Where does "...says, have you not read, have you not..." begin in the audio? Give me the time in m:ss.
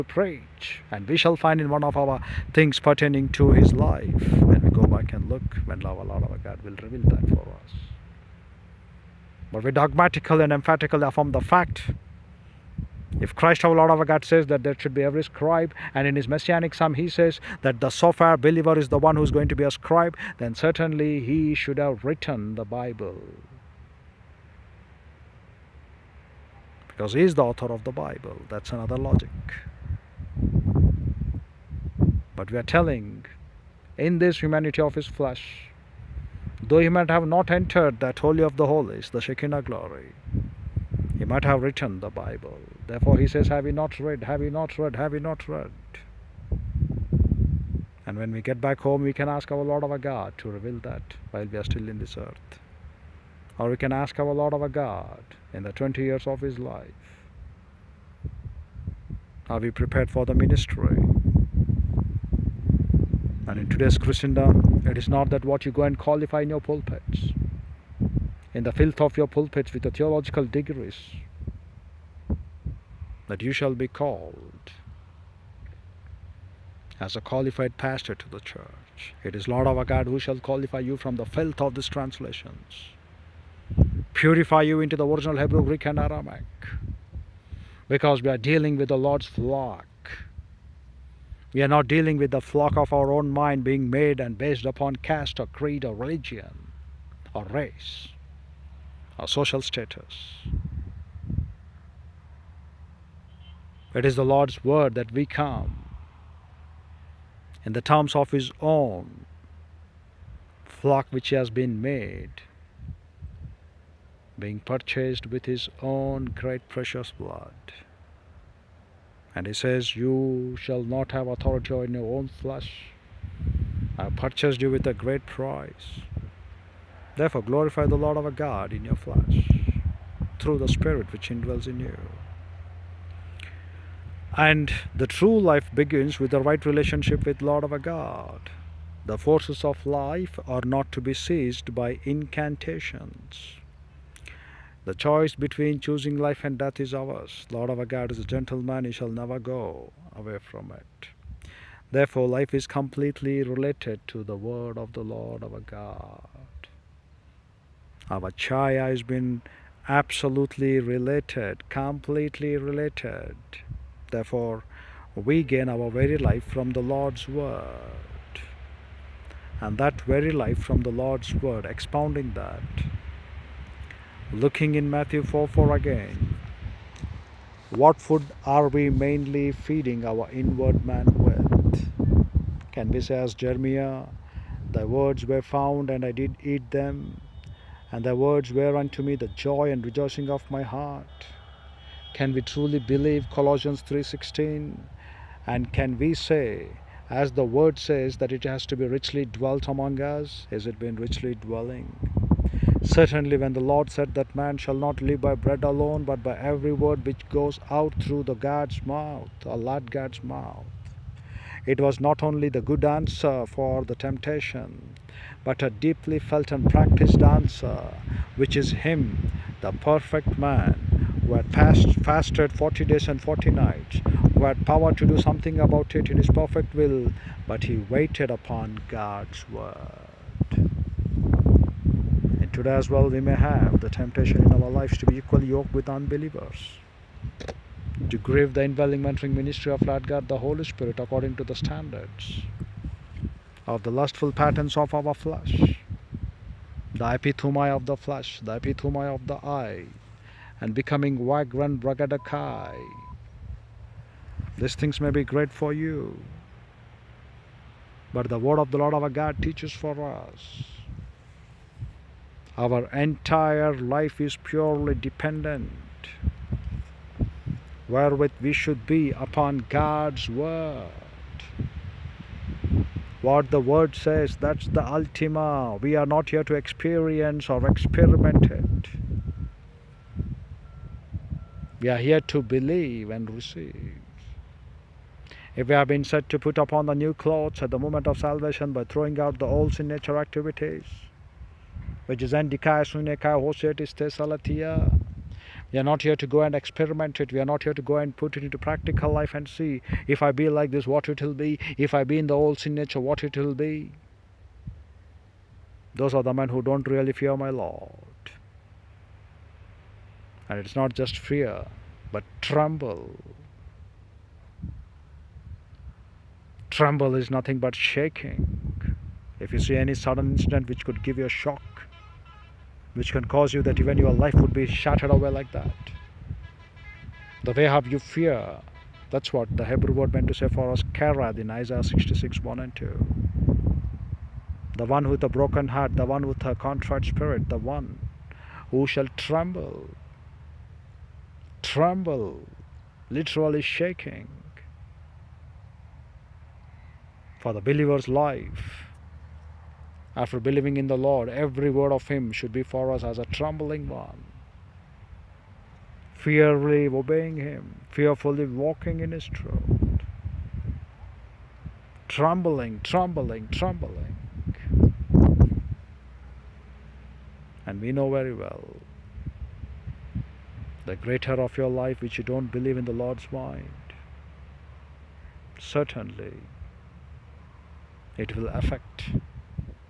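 0:43.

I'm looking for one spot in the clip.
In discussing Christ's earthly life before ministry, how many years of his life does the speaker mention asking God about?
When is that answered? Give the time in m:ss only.
0:55.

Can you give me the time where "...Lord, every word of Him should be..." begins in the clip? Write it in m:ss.
5:50.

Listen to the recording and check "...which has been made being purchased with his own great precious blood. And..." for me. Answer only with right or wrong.
right.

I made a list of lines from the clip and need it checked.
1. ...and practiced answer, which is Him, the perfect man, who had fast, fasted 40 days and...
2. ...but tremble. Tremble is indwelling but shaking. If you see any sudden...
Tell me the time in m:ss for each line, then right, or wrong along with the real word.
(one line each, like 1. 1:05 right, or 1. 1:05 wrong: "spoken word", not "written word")
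1. 3:36 right
2. 5:12 wrong: "nothing", not "indwelling".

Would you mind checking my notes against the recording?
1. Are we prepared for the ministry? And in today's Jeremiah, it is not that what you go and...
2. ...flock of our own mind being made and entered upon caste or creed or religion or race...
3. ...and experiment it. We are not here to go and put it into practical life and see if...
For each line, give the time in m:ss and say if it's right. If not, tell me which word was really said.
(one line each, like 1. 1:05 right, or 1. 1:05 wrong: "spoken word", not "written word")
1. 0:59 wrong: "Christendom", not "Jeremiah"
2. 1:32 wrong: "based", not "entered"
3. 4:56 right.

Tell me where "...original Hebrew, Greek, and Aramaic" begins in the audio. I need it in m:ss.
1:25.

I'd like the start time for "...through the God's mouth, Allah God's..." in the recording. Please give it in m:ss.
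3:27.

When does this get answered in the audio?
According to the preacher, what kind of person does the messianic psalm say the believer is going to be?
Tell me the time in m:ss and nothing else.
0:19.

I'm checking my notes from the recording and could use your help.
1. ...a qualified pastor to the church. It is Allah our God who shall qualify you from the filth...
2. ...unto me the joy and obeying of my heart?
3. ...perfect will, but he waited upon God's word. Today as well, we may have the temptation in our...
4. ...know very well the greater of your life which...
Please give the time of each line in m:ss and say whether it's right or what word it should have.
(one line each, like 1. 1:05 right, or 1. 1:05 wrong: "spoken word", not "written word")
1. 1:17 wrong: "Lord", not "Allah"
2. 3:08 wrong: "rejoicing", not "obeying"
3. 3:46 right
4. 6:07 right.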